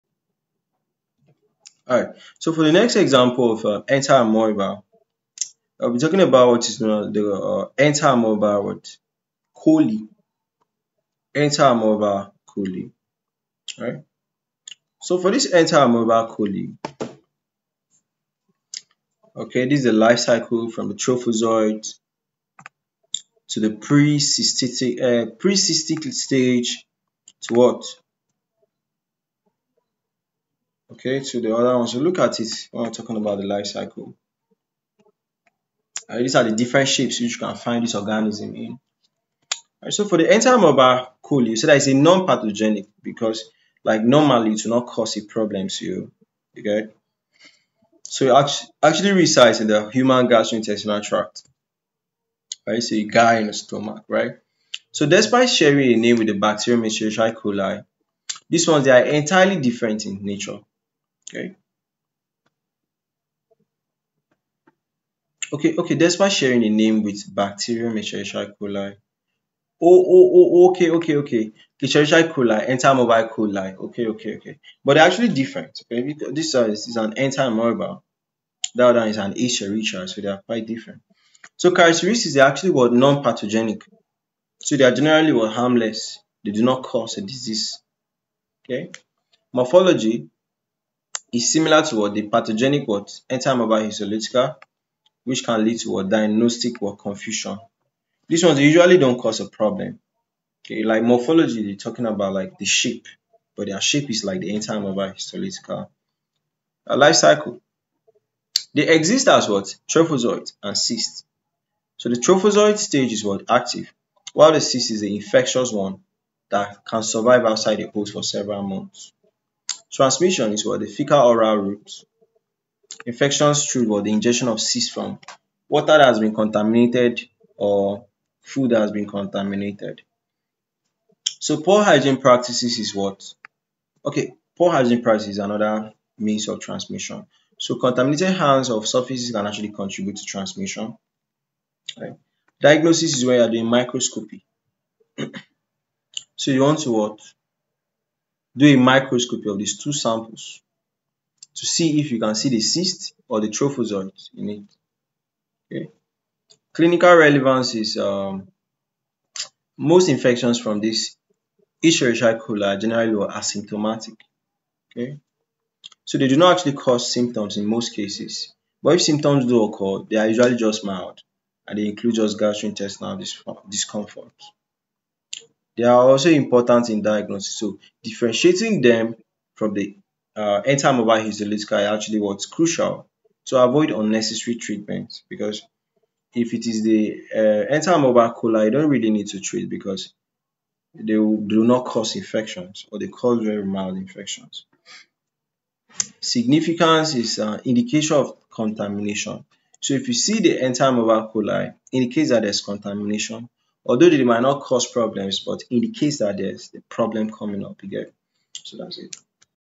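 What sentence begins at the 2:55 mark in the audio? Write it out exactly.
They are also important in diagnosis.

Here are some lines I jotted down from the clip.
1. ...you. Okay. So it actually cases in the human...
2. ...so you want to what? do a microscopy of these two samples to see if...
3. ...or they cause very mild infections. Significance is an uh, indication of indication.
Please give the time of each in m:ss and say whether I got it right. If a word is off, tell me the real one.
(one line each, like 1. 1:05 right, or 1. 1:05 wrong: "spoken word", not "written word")
1. 0:45 wrong: "resides", not "cases"
2. 2:26 right
3. 3:12 wrong: "contamination", not "indication".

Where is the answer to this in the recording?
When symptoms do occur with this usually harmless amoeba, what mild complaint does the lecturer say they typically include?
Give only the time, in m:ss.
2:52.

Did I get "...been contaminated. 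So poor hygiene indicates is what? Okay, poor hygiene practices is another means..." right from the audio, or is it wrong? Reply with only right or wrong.
wrong.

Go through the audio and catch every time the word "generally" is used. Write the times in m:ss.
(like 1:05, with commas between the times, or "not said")
1:24, 2:42.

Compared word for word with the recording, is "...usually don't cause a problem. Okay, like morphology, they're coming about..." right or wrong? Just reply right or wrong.
wrong.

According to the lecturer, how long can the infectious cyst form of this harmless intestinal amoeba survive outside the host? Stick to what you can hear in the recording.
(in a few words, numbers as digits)
several months.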